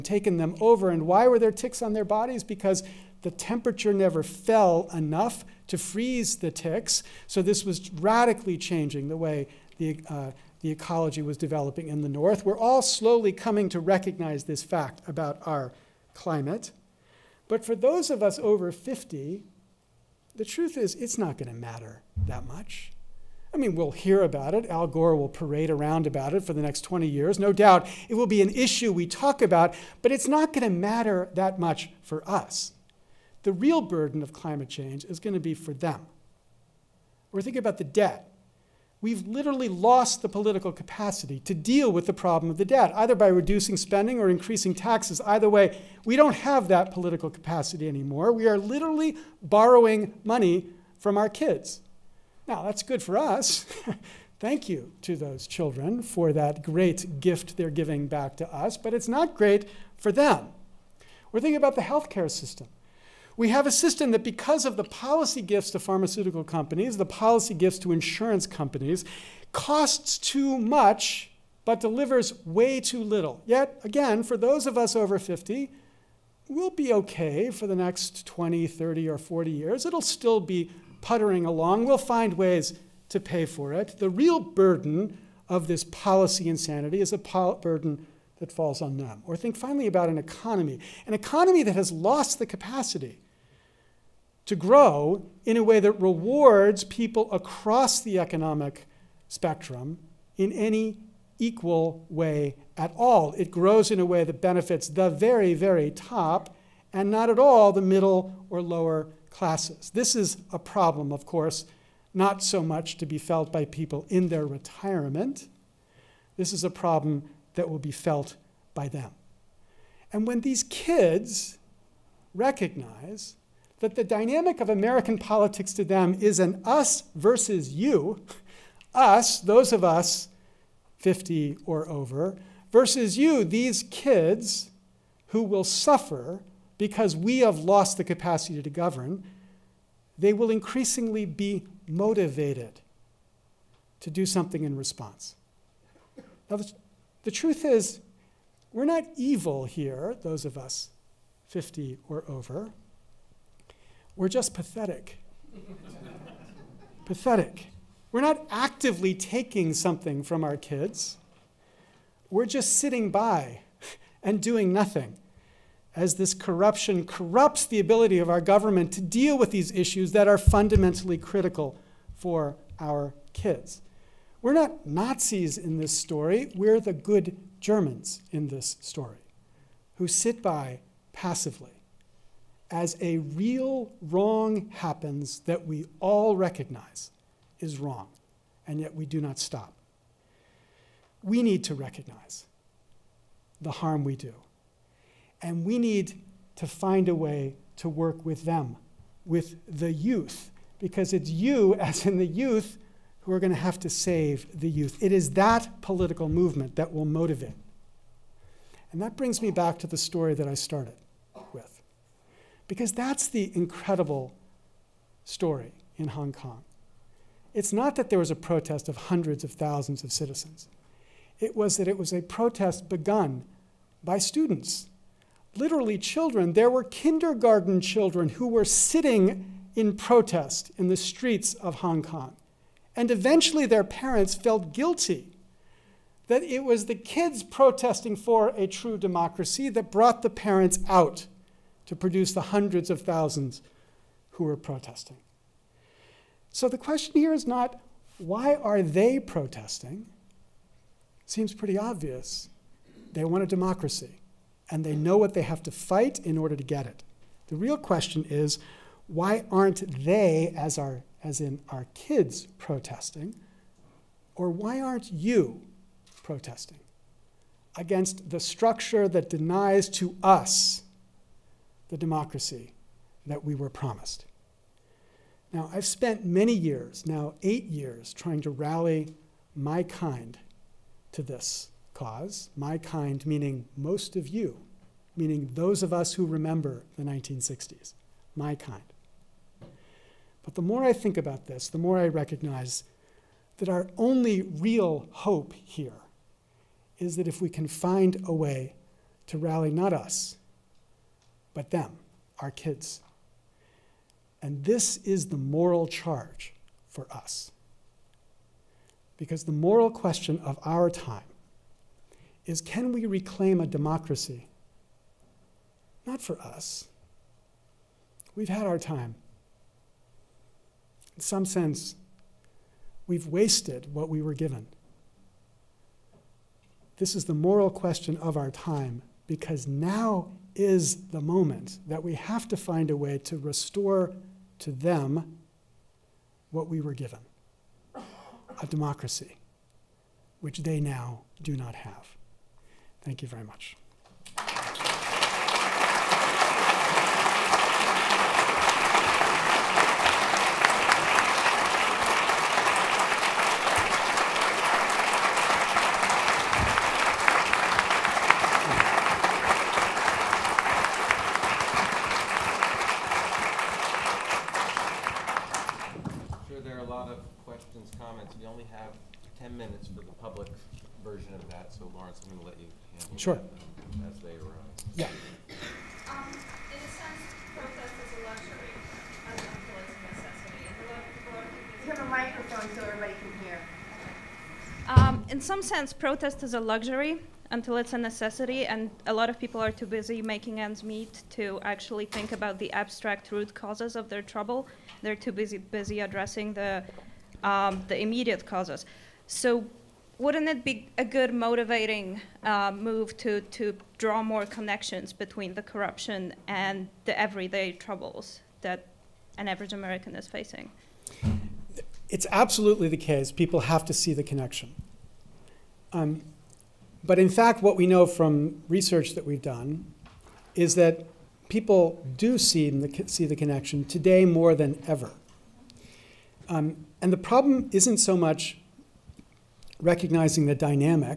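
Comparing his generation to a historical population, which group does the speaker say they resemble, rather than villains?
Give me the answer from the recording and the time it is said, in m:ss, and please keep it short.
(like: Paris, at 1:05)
the good Germans, at 2:56.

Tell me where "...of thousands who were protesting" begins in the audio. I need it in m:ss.
4:02.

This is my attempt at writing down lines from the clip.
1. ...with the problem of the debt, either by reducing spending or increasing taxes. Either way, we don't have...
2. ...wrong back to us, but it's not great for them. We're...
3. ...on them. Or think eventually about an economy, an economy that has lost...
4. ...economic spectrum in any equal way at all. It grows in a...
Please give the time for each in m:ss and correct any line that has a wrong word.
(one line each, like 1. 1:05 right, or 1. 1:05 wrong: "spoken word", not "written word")
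1. 0:41 right
2. 0:57 wrong: "giving", not "wrong"
3. 1:28 wrong: "finally", not "eventually"
4. 1:38 right.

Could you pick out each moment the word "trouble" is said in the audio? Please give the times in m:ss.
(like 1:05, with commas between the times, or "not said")
6:34, 6:47.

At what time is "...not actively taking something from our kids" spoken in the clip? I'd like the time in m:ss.
2:38.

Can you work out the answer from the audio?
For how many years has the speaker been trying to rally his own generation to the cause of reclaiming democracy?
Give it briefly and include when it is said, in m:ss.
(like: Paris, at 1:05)
8, at 4:37.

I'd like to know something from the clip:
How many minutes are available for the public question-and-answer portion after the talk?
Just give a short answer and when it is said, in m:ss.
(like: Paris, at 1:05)
10, at 6:09.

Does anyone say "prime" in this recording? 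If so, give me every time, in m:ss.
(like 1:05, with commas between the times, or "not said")
not said.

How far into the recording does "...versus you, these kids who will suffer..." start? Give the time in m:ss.
2:12.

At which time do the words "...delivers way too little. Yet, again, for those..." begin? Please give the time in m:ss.
1:11.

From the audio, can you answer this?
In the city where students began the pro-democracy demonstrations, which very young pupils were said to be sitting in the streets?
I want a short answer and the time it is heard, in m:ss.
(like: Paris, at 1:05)
kindergarten children, at 3:46.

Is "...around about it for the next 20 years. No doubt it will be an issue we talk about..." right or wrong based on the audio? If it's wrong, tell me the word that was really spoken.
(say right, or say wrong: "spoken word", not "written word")
right.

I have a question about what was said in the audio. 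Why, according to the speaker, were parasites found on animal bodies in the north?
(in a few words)
temperature never fell enough.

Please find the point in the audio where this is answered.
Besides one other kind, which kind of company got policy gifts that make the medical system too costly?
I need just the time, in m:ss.
1:05.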